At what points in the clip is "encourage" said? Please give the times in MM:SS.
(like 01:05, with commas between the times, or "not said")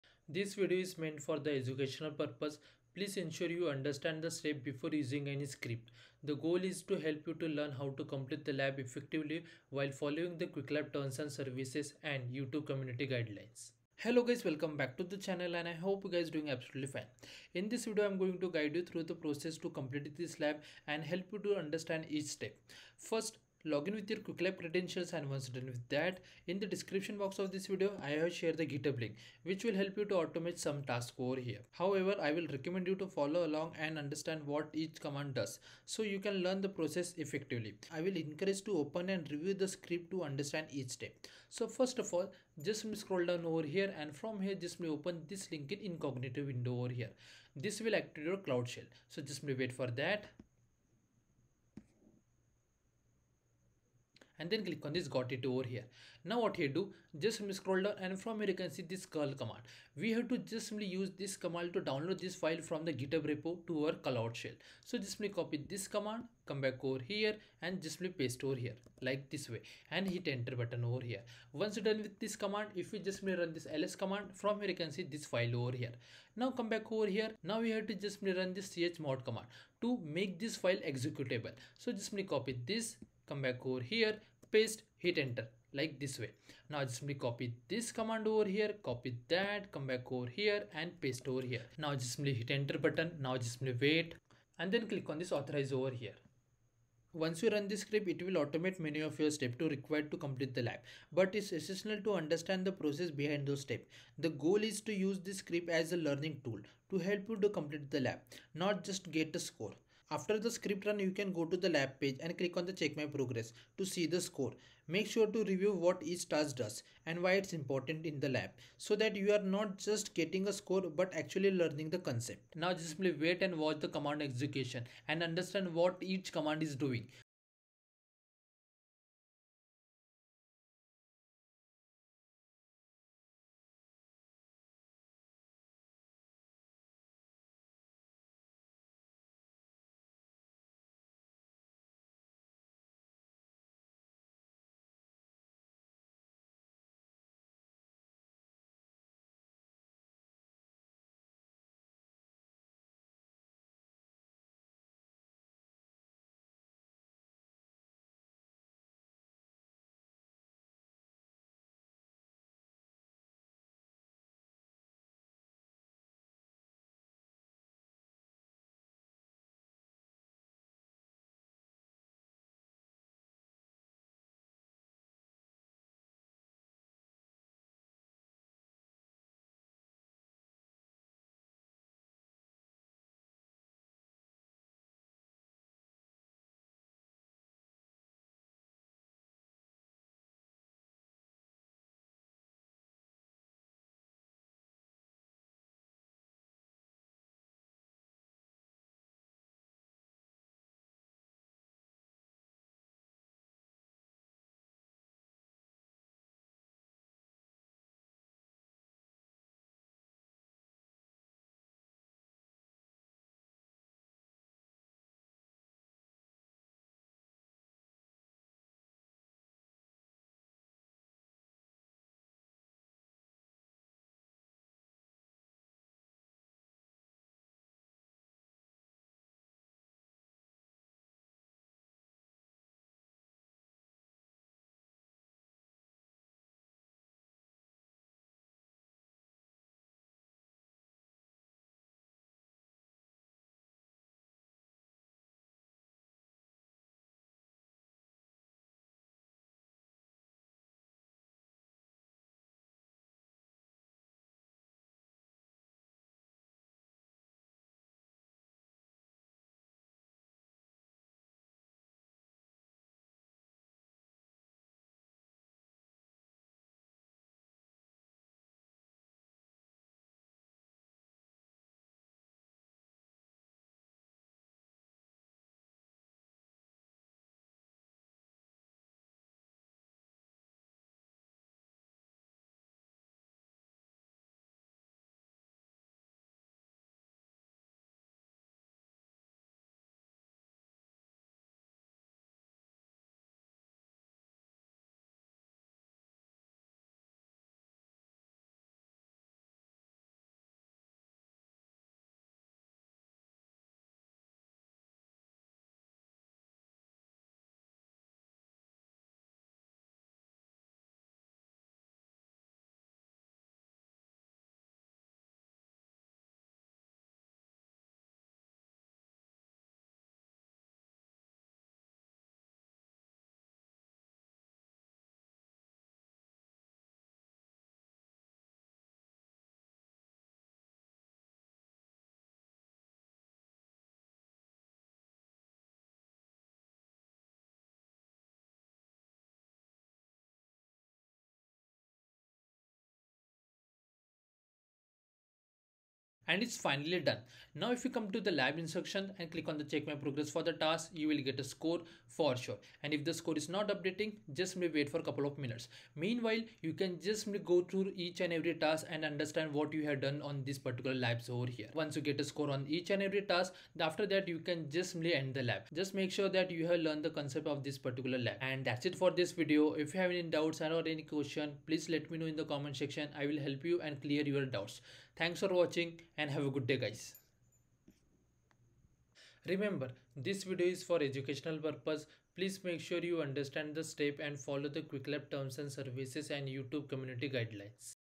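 00:38.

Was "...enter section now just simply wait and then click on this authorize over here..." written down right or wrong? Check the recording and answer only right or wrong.
wrong.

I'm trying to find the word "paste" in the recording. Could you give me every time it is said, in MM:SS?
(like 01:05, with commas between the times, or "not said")
01:08, 01:24, 01:31.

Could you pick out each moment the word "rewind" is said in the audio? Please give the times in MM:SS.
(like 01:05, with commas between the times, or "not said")
not said.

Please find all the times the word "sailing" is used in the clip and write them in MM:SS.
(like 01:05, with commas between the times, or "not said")
not said.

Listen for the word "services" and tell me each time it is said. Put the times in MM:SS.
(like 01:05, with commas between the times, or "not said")
00:11, 06:25.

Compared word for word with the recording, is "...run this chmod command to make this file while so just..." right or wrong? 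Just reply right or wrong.
wrong.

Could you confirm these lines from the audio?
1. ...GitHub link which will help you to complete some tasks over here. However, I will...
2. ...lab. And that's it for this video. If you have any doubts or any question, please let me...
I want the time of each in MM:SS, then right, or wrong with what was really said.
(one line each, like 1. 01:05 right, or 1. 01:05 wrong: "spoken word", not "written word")
1. 00:28 wrong: "automate", not "complete"
2. 06:08 right.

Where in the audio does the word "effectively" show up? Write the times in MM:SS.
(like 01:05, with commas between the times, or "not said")
00:08, 00:37.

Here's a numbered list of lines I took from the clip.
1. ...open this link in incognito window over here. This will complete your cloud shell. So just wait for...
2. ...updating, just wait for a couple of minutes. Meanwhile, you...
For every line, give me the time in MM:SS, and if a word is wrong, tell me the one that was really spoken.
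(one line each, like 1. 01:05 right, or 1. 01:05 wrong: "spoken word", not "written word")
1. 00:44 wrong: "activate", not "complete"
2. 05:53 right.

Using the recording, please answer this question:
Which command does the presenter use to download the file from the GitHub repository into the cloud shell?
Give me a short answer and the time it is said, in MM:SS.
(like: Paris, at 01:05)
curl, at 00:59.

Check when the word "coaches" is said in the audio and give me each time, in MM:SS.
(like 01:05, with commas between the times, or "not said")
not said.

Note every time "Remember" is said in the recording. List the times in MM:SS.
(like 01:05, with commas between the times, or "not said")
06:19.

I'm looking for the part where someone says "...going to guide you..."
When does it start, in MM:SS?
00:18.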